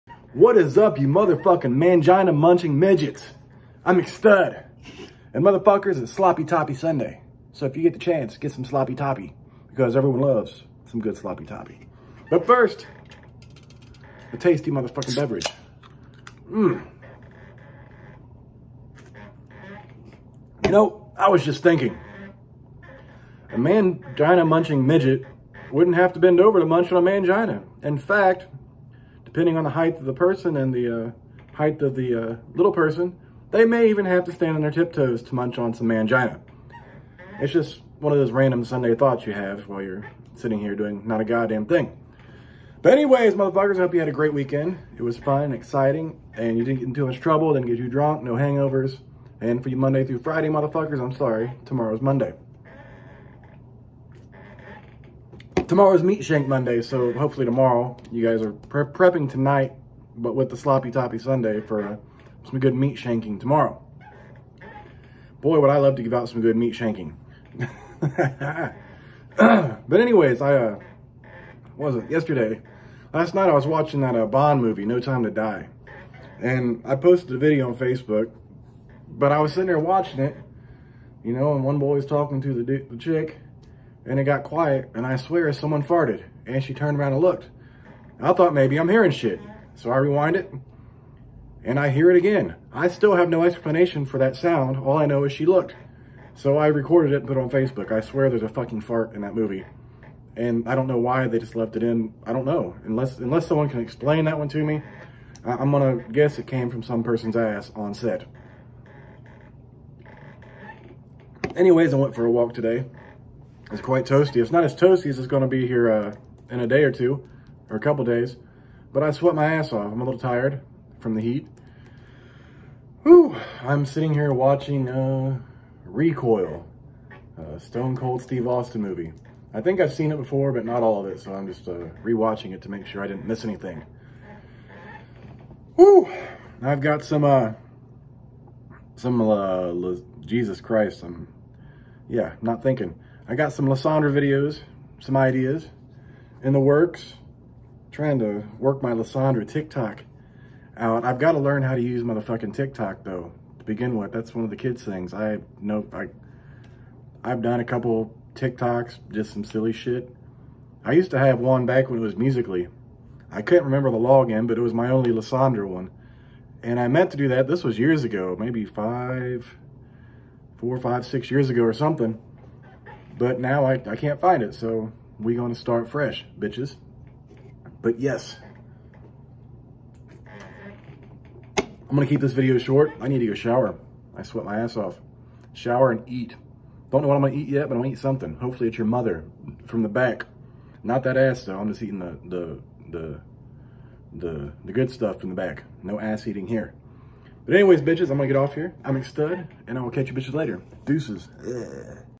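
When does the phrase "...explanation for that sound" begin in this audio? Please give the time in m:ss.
1:33.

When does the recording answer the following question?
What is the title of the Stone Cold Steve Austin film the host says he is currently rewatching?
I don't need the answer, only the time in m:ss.
2:05.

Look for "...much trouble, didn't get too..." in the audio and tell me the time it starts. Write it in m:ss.
0:47.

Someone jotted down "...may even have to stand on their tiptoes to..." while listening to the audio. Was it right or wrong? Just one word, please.
right.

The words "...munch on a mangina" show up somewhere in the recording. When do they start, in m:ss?
0:26.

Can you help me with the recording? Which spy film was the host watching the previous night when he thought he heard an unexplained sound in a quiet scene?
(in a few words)
No Time to Die.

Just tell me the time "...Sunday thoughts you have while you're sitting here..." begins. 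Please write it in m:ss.
0:38.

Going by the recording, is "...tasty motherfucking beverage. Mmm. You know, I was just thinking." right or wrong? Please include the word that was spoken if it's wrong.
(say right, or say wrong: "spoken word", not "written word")
right.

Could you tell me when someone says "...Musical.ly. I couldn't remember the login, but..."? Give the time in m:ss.
2:42.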